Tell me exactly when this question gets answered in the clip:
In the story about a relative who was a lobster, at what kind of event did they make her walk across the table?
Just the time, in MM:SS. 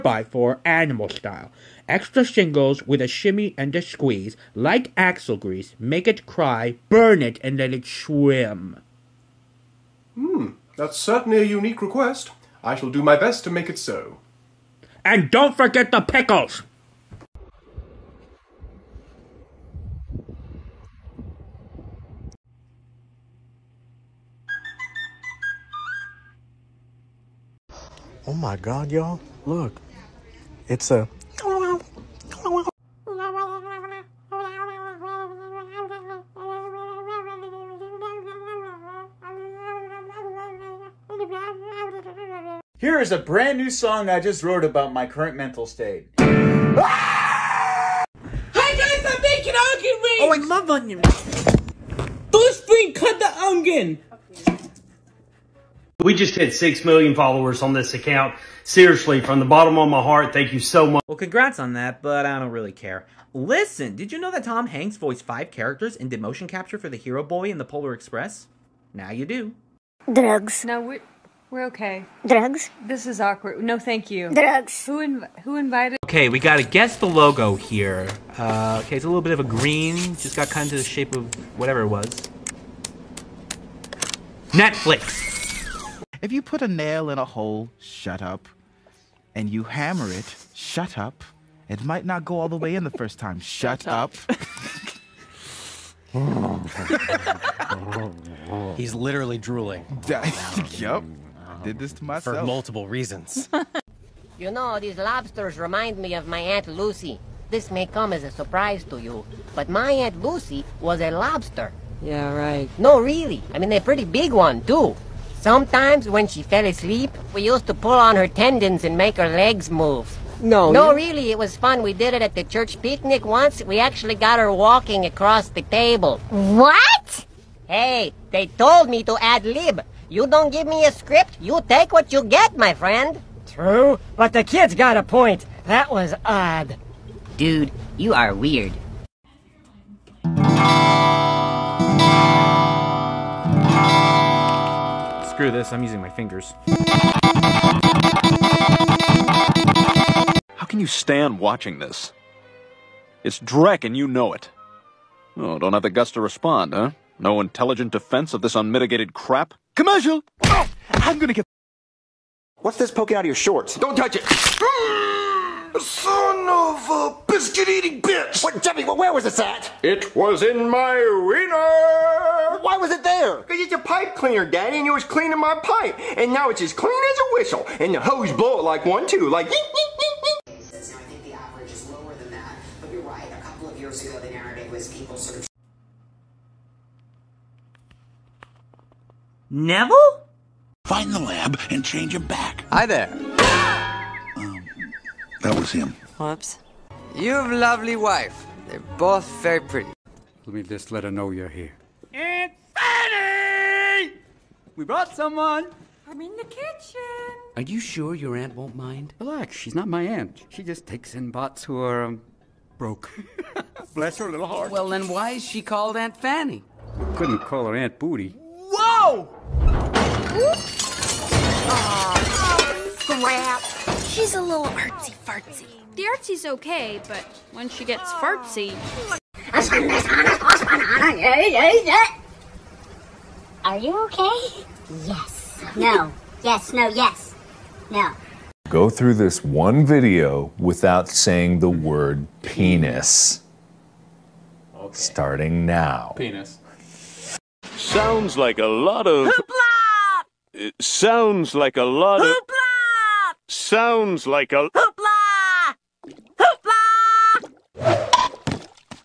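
02:02.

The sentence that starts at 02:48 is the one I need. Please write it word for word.
What, Jimmy, where was this at?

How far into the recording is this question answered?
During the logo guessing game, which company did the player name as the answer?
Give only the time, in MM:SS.
01:24.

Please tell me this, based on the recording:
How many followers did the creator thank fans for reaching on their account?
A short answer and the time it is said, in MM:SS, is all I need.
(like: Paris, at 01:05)
6 million, at 00:56.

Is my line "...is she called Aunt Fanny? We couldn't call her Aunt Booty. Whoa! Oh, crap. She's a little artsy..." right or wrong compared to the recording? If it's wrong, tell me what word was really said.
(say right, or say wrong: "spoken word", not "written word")
right.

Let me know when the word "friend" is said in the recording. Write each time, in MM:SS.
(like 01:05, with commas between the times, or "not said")
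02:12.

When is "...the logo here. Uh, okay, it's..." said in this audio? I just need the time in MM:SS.
01:16.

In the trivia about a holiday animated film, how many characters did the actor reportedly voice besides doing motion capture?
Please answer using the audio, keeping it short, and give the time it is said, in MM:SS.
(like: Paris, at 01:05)
5, at 01:05.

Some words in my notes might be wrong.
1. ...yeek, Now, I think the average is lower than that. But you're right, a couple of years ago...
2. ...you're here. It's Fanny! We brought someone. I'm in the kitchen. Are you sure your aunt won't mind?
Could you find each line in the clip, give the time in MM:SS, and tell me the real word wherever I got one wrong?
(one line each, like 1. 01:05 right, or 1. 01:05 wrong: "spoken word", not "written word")
1. 03:00 right
2. 03:21 right.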